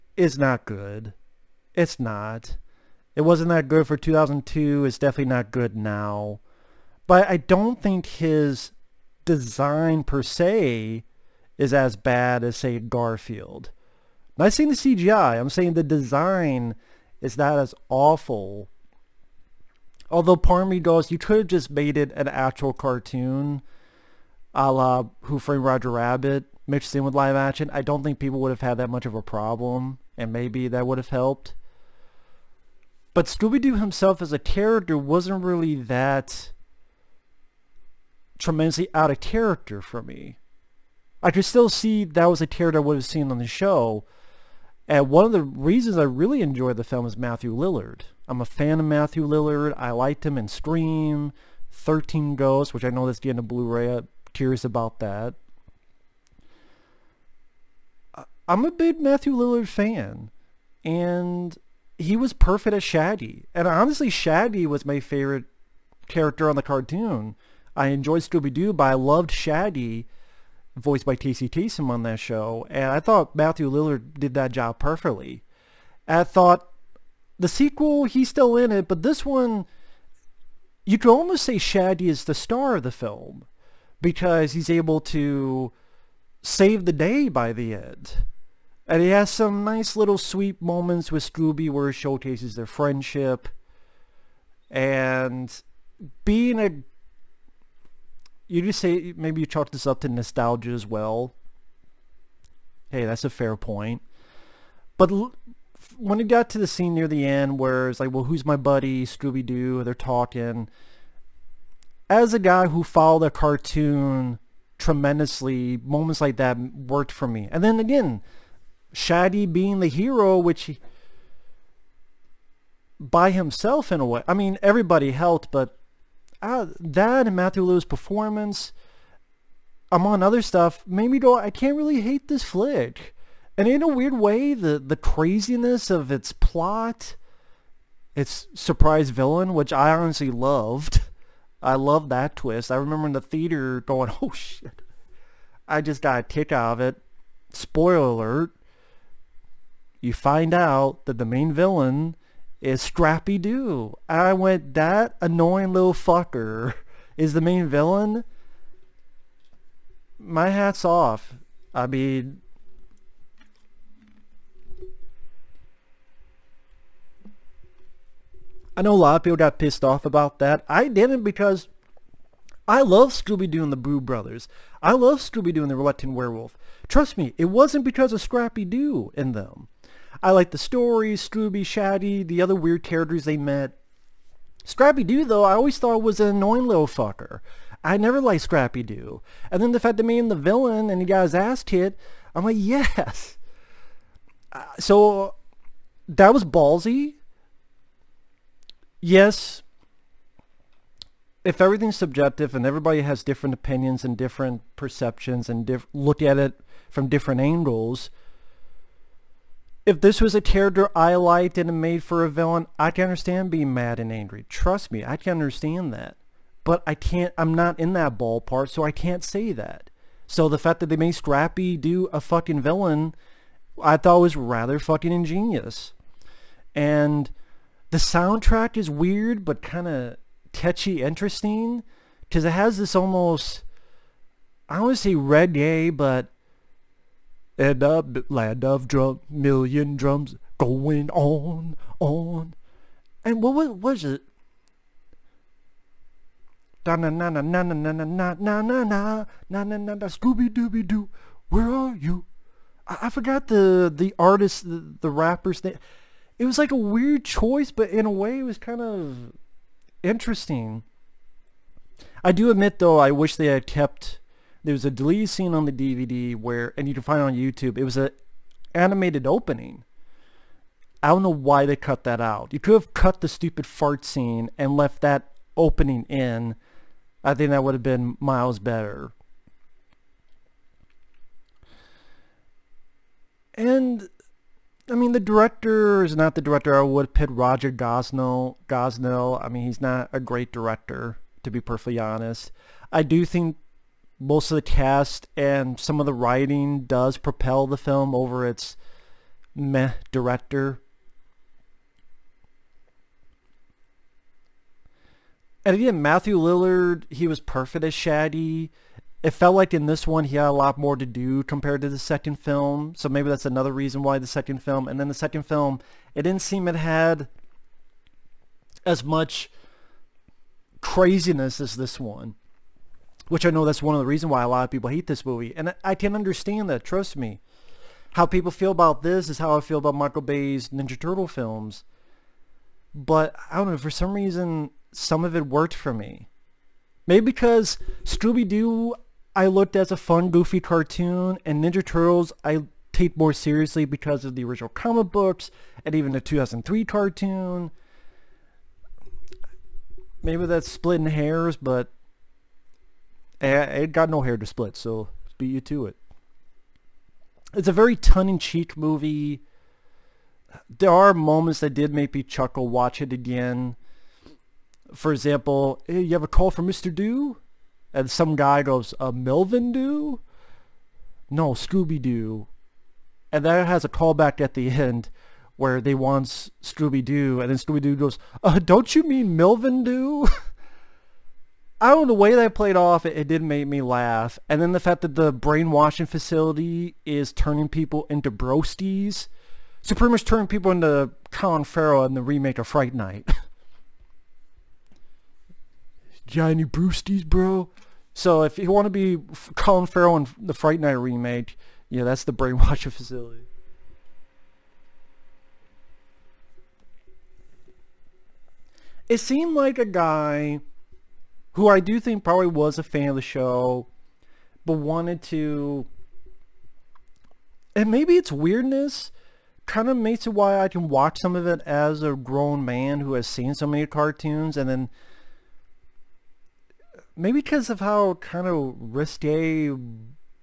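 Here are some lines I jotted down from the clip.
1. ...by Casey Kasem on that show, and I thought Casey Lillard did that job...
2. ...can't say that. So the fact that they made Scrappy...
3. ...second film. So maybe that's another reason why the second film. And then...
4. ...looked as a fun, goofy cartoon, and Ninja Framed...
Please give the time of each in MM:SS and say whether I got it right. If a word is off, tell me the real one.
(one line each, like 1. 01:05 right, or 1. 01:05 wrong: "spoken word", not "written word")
1. 01:11 wrong: "Matthew", not "Casey"
2. 03:38 right
3. 05:11 right
4. 05:39 wrong: "Turtles", not "Framed".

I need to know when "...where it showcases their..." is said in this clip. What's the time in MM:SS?
01:31.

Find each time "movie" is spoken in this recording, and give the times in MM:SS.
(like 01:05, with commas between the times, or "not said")
05:25, 05:58.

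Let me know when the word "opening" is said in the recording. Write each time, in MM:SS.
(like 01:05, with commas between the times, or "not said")
04:29, 04:35.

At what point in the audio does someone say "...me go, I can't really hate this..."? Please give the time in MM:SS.
02:11.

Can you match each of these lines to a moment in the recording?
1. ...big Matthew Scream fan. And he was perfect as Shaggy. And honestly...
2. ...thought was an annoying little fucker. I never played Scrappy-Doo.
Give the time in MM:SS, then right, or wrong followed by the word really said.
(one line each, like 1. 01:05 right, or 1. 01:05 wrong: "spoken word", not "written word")
1. 00:58 wrong: "Lillard", not "Scream"
2. 03:05 wrong: "liked", not "played".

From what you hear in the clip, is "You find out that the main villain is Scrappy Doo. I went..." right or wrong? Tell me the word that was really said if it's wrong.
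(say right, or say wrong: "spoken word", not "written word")
right.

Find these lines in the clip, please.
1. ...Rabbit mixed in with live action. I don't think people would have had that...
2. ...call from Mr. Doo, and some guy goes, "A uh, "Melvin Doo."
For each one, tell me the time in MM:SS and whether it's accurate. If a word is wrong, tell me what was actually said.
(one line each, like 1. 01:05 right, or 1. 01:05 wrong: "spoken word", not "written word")
1. 00:25 right
2. 06:06 right.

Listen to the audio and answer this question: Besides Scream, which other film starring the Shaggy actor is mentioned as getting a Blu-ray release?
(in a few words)
13 Ghosts.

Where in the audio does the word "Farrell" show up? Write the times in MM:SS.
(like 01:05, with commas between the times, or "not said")
06:31, 06:39.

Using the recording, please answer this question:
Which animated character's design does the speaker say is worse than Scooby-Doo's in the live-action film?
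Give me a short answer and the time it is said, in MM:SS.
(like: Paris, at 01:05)
Garfield, at 00:12.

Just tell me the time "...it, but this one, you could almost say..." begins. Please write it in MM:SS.
01:18.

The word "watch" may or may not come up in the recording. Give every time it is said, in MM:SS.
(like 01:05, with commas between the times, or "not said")
06:02, 07:00.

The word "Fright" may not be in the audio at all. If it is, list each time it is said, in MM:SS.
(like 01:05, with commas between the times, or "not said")
06:32, 06:40.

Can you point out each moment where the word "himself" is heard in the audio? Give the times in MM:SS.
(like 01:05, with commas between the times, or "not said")
00:33, 02:03.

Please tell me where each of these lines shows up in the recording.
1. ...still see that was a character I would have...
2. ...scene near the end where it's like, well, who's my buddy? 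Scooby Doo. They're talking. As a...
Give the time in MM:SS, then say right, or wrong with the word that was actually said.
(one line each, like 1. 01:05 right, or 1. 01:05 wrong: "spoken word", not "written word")
1. 00:41 right
2. 01:46 right.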